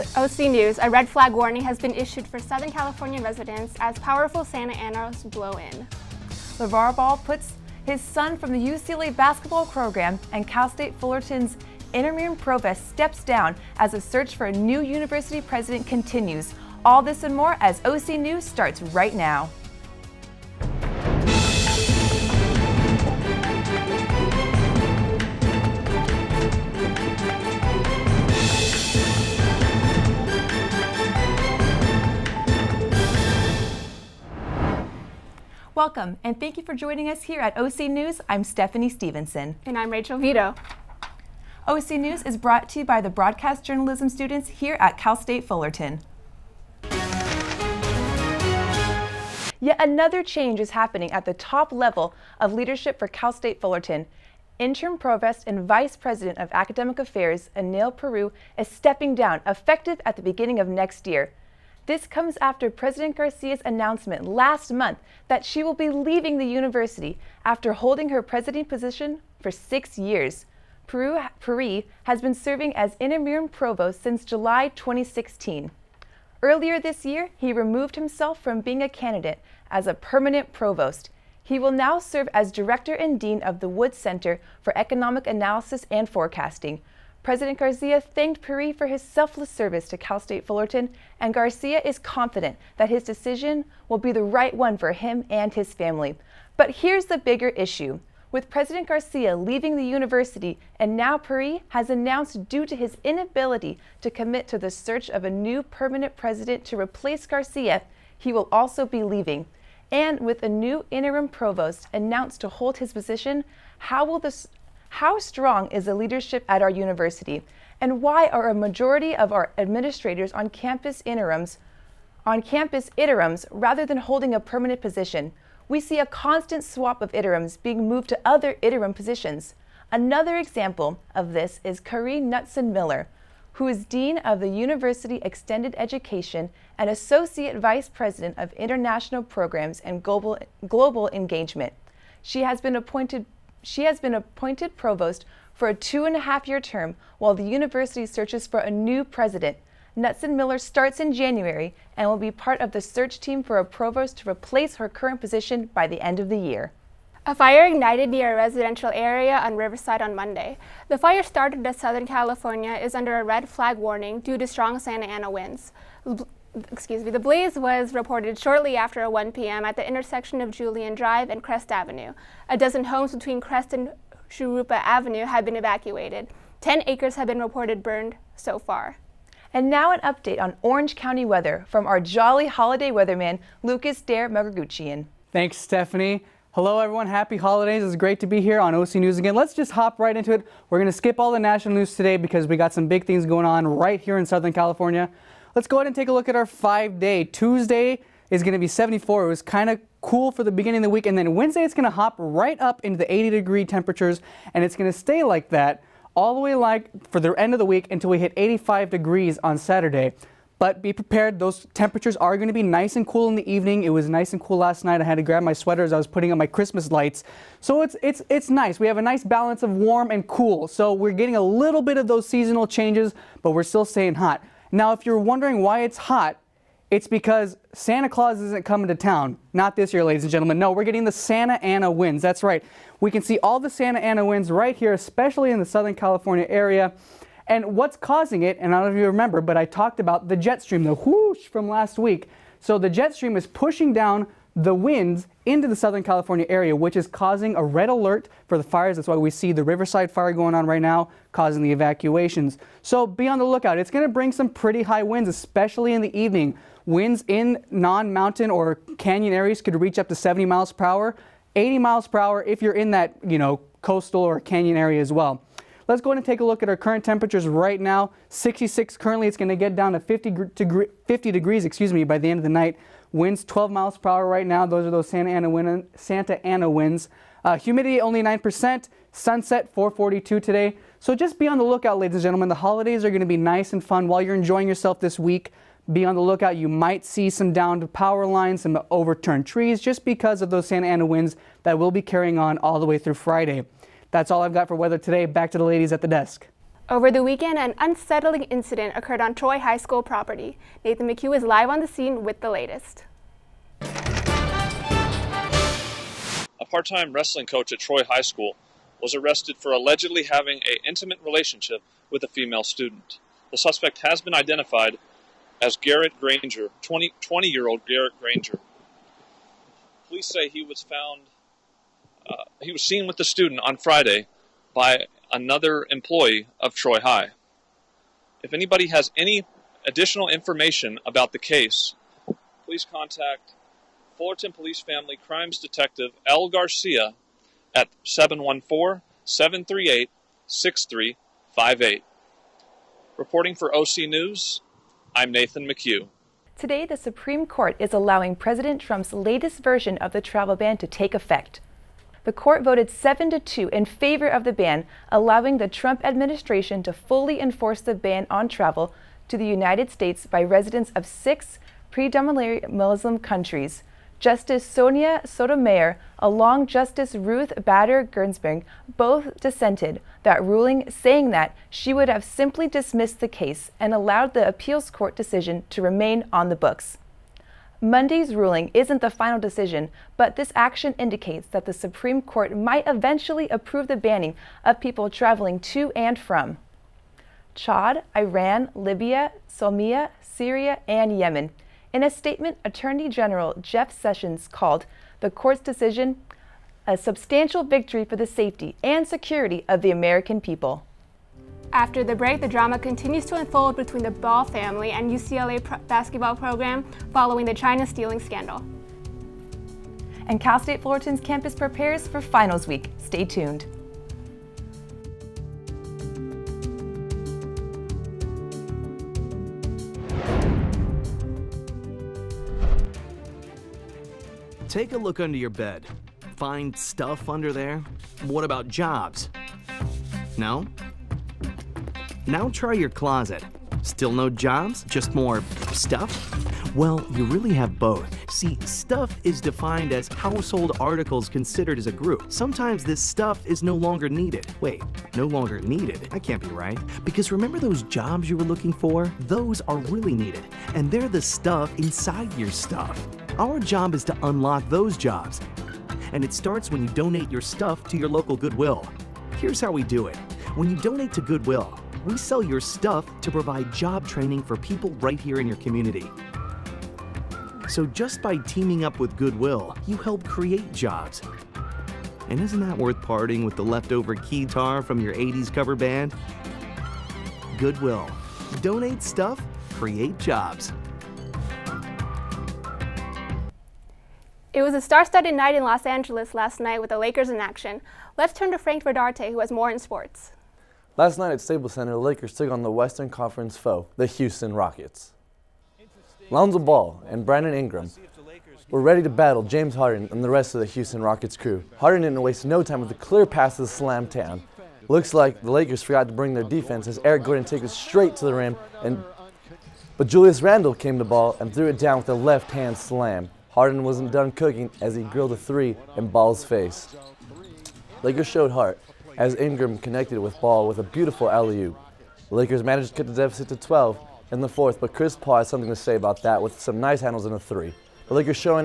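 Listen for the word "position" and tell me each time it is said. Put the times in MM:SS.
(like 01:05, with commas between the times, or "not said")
01:08, 01:52, 02:04, 02:08, 02:35.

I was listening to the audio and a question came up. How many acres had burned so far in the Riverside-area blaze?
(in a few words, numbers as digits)
10.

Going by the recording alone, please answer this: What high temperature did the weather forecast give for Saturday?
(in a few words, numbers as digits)
85 degrees.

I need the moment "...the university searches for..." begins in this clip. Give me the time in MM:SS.
02:27.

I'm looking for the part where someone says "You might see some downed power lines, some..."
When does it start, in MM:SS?
04:46.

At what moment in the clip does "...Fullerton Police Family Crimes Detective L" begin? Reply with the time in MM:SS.
05:34.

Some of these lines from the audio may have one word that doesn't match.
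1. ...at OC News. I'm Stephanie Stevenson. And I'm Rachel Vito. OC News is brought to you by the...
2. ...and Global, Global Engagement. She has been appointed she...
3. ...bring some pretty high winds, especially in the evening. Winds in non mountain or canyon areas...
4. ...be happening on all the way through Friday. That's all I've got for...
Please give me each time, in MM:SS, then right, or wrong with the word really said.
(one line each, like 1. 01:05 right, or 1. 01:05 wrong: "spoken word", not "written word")
1. 00:37 right
2. 02:19 right
3. 04:14 right
4. 04:51 wrong: "carrying", not "happening".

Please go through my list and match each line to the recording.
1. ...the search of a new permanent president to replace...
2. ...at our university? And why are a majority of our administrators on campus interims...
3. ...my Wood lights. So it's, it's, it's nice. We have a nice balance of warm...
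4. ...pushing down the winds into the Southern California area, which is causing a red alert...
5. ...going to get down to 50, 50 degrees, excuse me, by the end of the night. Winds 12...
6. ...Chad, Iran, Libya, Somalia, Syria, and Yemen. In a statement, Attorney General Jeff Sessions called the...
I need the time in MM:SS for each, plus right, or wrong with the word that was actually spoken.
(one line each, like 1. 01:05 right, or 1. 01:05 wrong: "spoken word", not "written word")
1. 01:44 right
2. 01:56 right
3. 03:36 wrong: "Christmas", not "Wood"
4. 04:03 right
5. 04:29 right
6. 06:27 right.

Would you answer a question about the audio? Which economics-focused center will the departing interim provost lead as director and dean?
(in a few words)
Wood Center for Economic Analysis and Forecasting.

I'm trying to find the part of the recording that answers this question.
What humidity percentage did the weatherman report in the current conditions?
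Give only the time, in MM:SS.
04:38.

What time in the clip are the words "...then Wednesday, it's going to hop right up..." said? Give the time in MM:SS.
03:21.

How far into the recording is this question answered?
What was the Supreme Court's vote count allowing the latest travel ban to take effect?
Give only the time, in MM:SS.
05:52.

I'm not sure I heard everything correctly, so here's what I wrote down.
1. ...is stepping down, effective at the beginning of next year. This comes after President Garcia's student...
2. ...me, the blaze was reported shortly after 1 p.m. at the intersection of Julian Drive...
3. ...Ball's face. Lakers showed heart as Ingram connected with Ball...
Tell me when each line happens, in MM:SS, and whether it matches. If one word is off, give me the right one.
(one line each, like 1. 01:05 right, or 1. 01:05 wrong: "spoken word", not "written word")
1. 00:58 wrong: "announcement", not "student"
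2. 02:47 right
3. 08:36 right.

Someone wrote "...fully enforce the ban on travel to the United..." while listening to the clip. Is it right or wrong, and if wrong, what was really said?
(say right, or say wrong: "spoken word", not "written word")
right.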